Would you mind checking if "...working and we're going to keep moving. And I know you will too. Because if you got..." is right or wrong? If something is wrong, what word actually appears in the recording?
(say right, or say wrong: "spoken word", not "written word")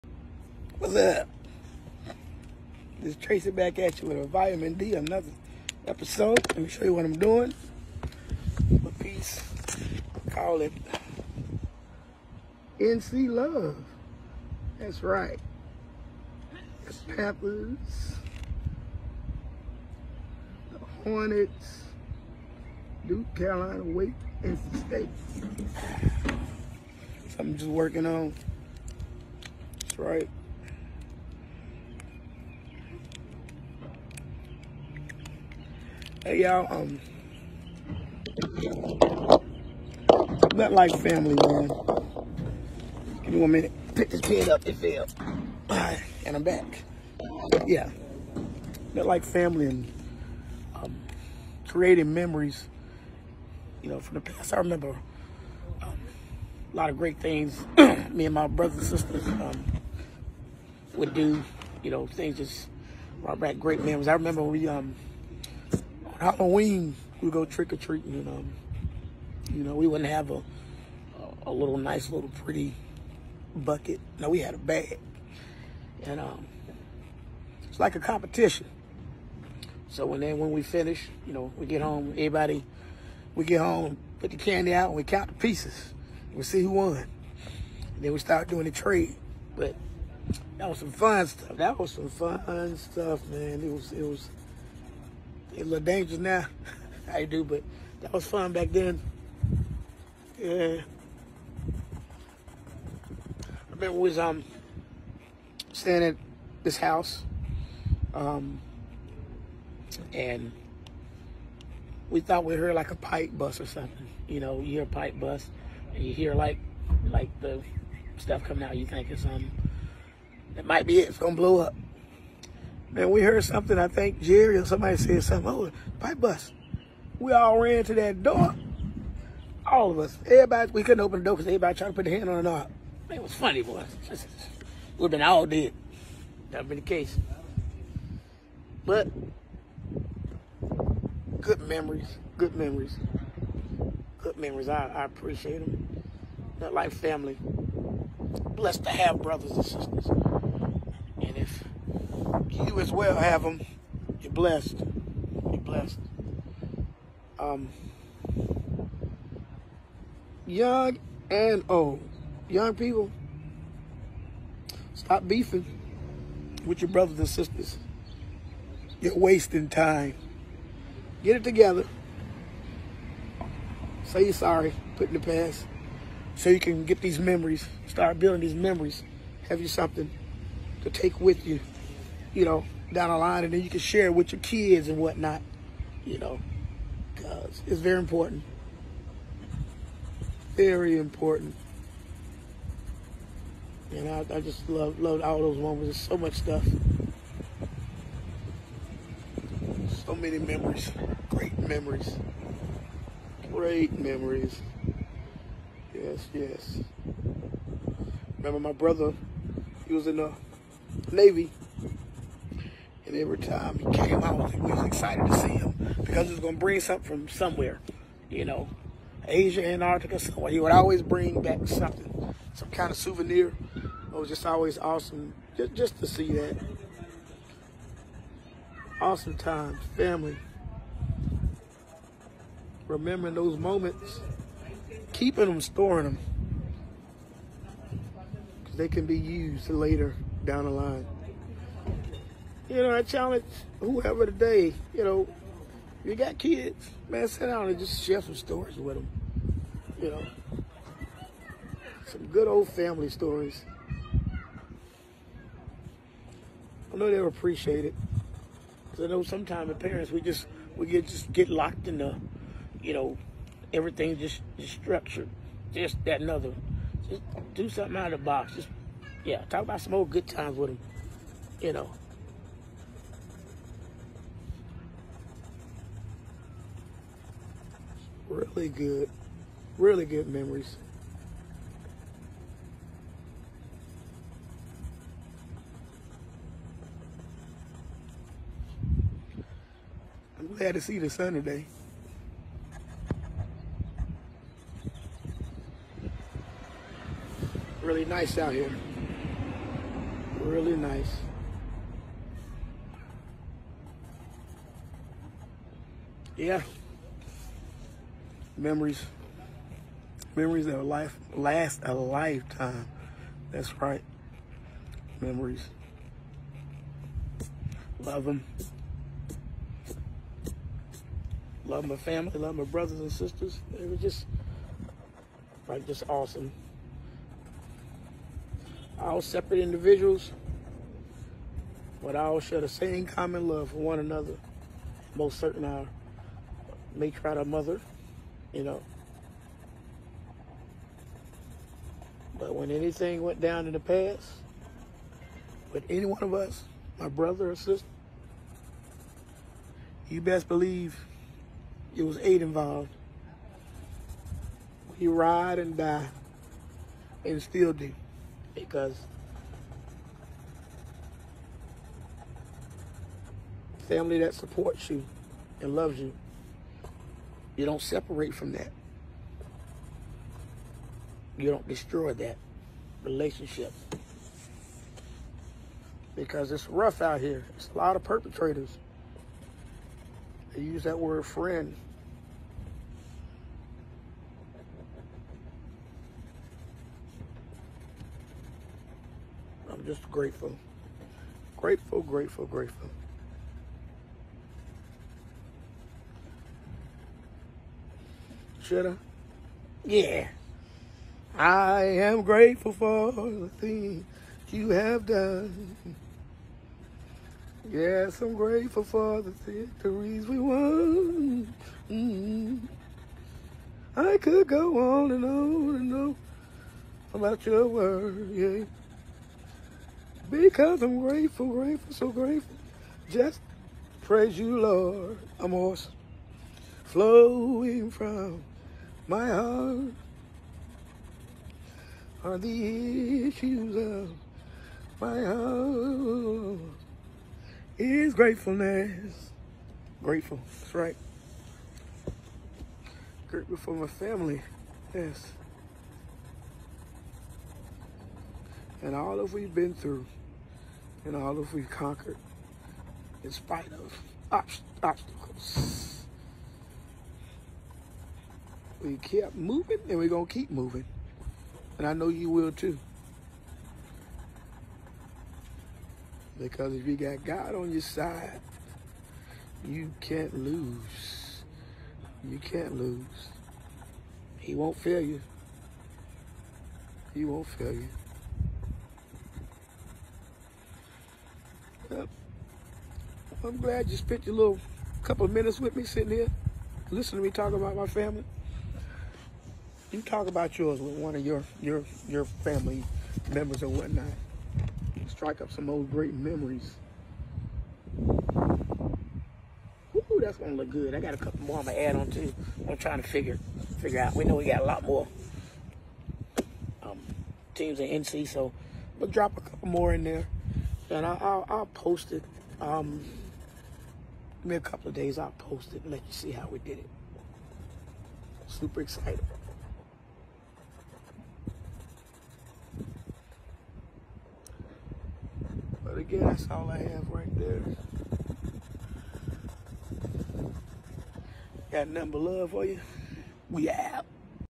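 wrong: "moving", not "working".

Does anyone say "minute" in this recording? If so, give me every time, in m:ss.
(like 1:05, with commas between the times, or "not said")
0:43, 8:05.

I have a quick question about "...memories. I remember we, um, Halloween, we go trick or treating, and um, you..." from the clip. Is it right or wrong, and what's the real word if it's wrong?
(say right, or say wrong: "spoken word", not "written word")
right.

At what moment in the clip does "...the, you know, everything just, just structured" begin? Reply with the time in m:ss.
4:21.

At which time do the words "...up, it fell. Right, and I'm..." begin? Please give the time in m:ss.
0:44.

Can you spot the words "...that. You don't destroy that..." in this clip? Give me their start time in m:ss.
6:08.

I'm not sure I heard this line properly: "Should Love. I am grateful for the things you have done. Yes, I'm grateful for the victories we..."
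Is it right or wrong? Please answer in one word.
wrong.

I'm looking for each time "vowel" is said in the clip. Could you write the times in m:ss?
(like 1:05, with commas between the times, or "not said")
not said.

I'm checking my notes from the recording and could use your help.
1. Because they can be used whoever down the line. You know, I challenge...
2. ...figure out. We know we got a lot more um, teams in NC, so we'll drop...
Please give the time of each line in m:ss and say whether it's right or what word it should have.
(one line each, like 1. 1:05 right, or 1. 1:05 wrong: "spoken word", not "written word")
1. 3:58 wrong: "later", not "whoever"
2. 8:23 right.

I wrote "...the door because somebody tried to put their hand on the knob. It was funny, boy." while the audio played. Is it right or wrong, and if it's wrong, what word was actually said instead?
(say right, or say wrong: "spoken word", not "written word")
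wrong: "everybody", not "somebody".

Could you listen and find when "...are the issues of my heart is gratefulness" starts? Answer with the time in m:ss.
7:12.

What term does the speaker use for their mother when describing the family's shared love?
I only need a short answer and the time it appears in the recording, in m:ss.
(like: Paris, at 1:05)
matriarch, at 5:36.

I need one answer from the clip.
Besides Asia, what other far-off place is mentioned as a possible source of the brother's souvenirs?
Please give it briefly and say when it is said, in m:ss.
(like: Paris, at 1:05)
Antarctica, at 3:39.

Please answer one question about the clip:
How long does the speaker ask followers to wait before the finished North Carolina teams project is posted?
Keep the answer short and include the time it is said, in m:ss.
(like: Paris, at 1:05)
a couple of days, at 8:34.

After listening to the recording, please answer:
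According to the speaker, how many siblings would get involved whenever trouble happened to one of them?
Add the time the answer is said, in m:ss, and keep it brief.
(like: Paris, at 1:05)
8, at 5:52.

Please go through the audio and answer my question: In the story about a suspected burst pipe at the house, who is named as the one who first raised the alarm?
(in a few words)
Jerry.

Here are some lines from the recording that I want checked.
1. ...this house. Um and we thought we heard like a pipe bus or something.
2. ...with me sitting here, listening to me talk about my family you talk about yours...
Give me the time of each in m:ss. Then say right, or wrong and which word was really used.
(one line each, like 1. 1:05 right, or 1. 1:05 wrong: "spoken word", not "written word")
1. 1:46 right
2. 8:05 right.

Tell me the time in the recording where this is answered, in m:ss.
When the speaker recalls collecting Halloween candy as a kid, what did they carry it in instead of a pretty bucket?
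1:14.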